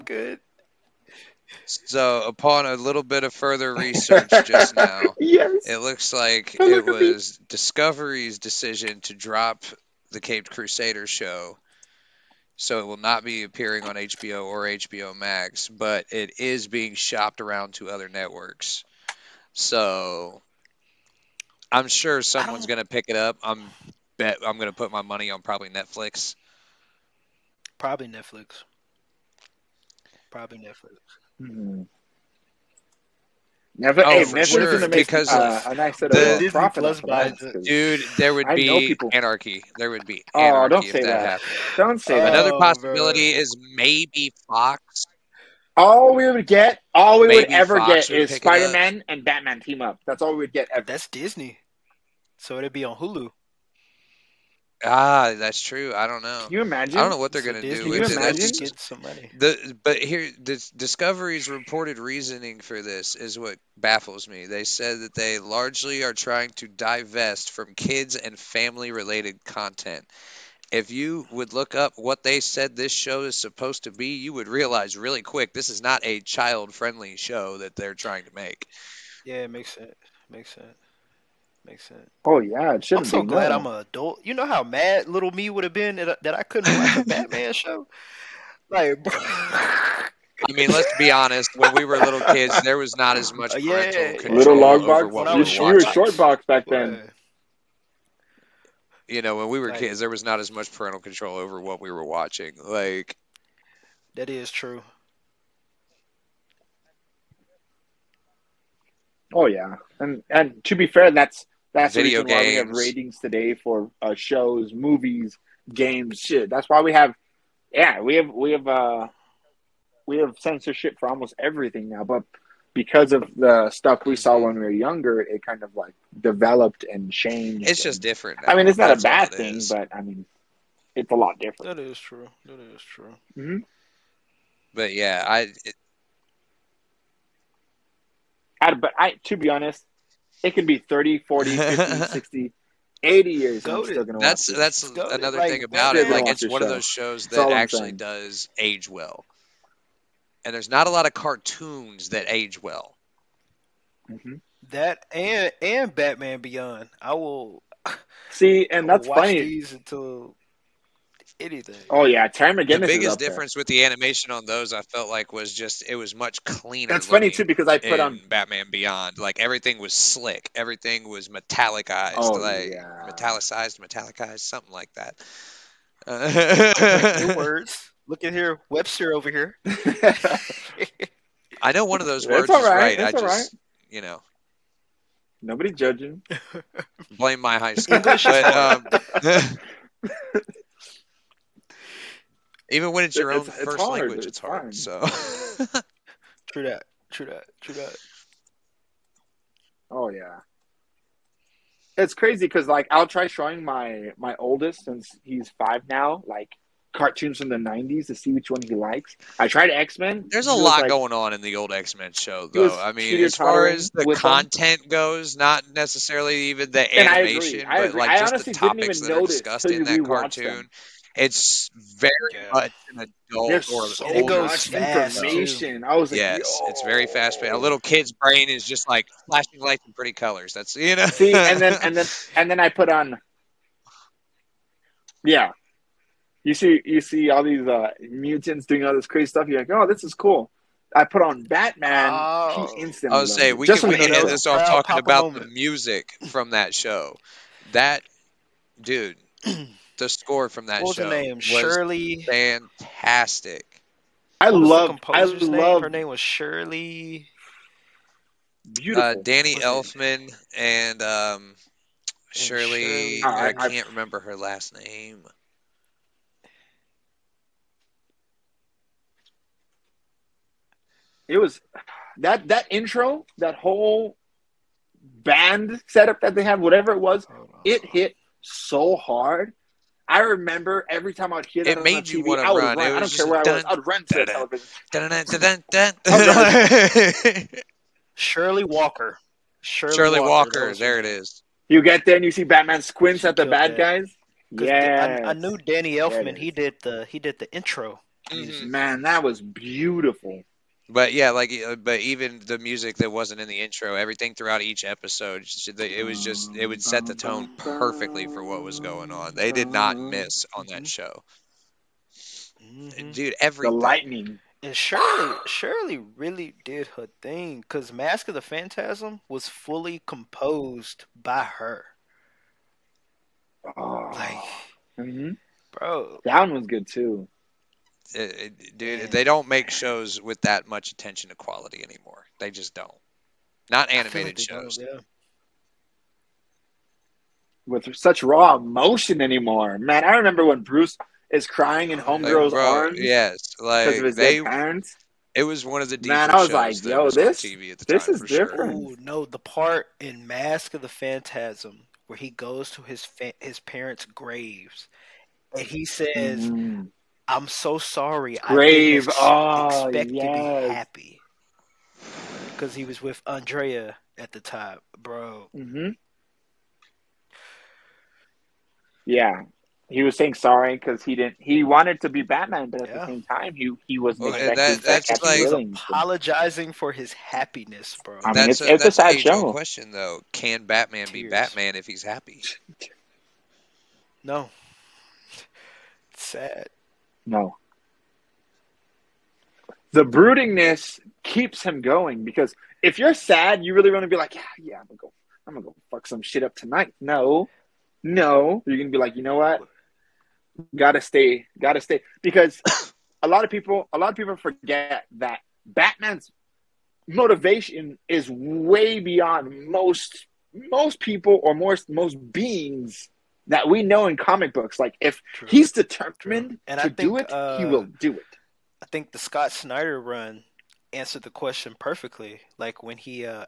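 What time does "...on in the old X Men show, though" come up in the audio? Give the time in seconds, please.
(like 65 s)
211 s.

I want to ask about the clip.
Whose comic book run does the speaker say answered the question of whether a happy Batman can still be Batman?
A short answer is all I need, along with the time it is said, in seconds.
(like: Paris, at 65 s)
Scott Snyder, at 419 s.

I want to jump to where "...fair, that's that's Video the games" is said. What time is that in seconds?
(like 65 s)
110 s.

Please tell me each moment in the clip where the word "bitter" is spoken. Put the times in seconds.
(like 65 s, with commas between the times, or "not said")
not said.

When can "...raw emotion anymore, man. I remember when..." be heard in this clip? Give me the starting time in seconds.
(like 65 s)
338 s.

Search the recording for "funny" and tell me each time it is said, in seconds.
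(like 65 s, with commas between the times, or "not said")
159 s, 167 s.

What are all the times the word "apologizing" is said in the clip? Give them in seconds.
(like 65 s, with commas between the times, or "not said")
375 s.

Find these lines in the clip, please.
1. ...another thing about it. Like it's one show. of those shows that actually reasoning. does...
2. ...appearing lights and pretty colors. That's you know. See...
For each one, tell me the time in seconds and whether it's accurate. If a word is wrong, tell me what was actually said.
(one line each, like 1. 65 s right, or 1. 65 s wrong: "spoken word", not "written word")
1. 144 s wrong: "saying", not "reasoning"
2. 229 s wrong: "flashing", not "appearing".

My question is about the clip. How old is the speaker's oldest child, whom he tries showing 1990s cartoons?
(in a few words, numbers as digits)
5.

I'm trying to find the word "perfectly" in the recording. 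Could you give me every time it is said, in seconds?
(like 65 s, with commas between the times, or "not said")
307 s, 421 s.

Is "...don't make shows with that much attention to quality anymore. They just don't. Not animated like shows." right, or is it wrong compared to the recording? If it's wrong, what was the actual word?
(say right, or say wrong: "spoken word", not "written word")
right.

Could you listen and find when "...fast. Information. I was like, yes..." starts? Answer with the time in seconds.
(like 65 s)
224 s.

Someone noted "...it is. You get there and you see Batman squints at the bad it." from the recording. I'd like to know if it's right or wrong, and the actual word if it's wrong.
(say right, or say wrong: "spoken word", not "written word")
right.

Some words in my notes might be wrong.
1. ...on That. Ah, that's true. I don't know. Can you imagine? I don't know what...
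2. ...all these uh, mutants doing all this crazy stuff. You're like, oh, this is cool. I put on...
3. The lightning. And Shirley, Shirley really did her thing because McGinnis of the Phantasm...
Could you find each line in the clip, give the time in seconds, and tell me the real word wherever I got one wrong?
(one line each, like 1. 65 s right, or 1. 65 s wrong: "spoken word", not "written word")
1. 52 s wrong: "Hulu", not "That"
2. 237 s right
3. 313 s wrong: "Mask", not "McGinnis".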